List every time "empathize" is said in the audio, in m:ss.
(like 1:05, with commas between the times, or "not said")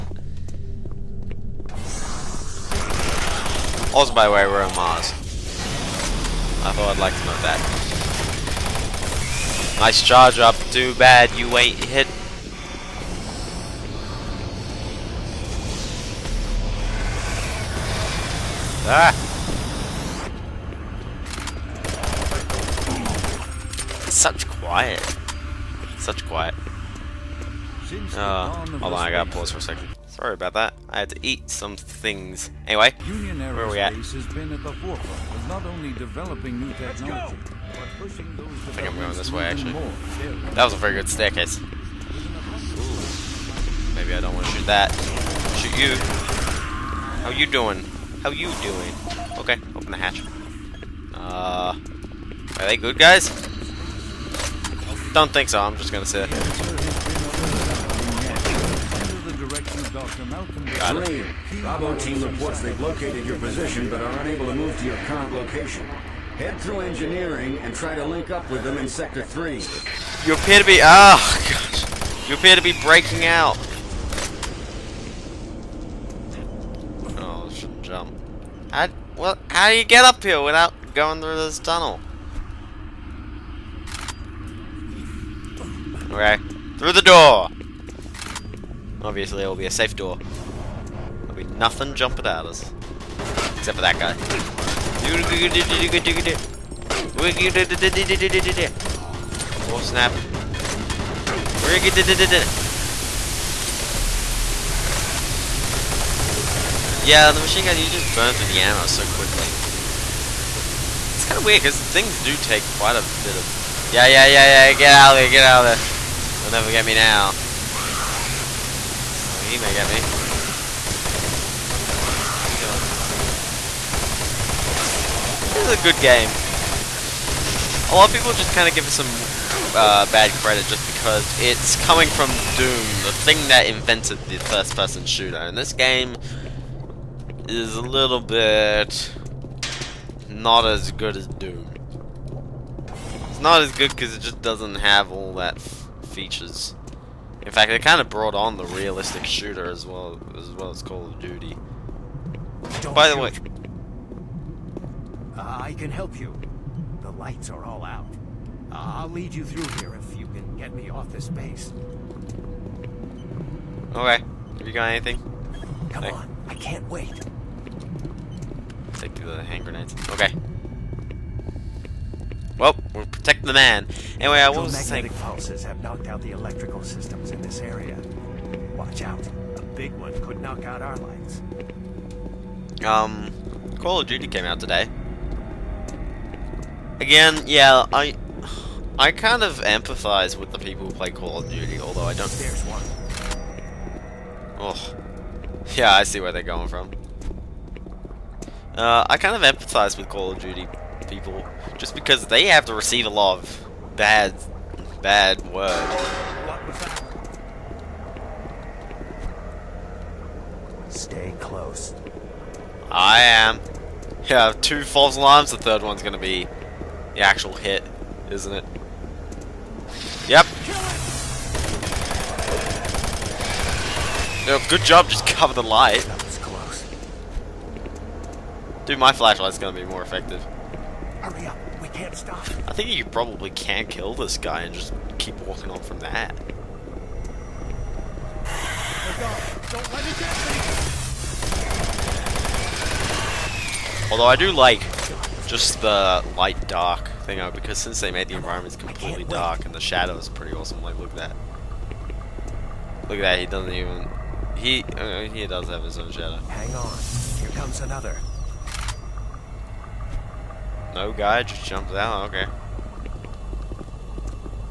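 3:09, 3:19.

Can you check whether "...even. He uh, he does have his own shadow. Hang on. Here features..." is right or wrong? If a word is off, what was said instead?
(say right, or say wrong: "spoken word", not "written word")
wrong: "comes", not "features".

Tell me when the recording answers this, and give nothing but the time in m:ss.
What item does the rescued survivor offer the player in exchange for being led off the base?
2:49.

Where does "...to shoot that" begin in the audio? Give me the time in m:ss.
0:44.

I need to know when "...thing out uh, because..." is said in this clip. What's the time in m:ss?
4:07.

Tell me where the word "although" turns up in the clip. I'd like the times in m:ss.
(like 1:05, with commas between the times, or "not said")
3:11, 4:04.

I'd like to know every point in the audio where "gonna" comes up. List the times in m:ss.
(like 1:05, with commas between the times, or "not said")
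0:55, 3:36, 3:49.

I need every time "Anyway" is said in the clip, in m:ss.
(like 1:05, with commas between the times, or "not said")
0:32, 2:54.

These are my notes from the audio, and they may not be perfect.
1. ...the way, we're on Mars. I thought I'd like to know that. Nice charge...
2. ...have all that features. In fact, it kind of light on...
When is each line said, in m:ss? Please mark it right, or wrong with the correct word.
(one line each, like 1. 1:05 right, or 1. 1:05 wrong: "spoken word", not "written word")
1. 0:04 right
2. 2:24 wrong: "brought", not "light".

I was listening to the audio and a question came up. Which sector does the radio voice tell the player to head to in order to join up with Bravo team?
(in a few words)
Sector 3.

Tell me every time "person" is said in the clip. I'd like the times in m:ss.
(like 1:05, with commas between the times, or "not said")
2:14.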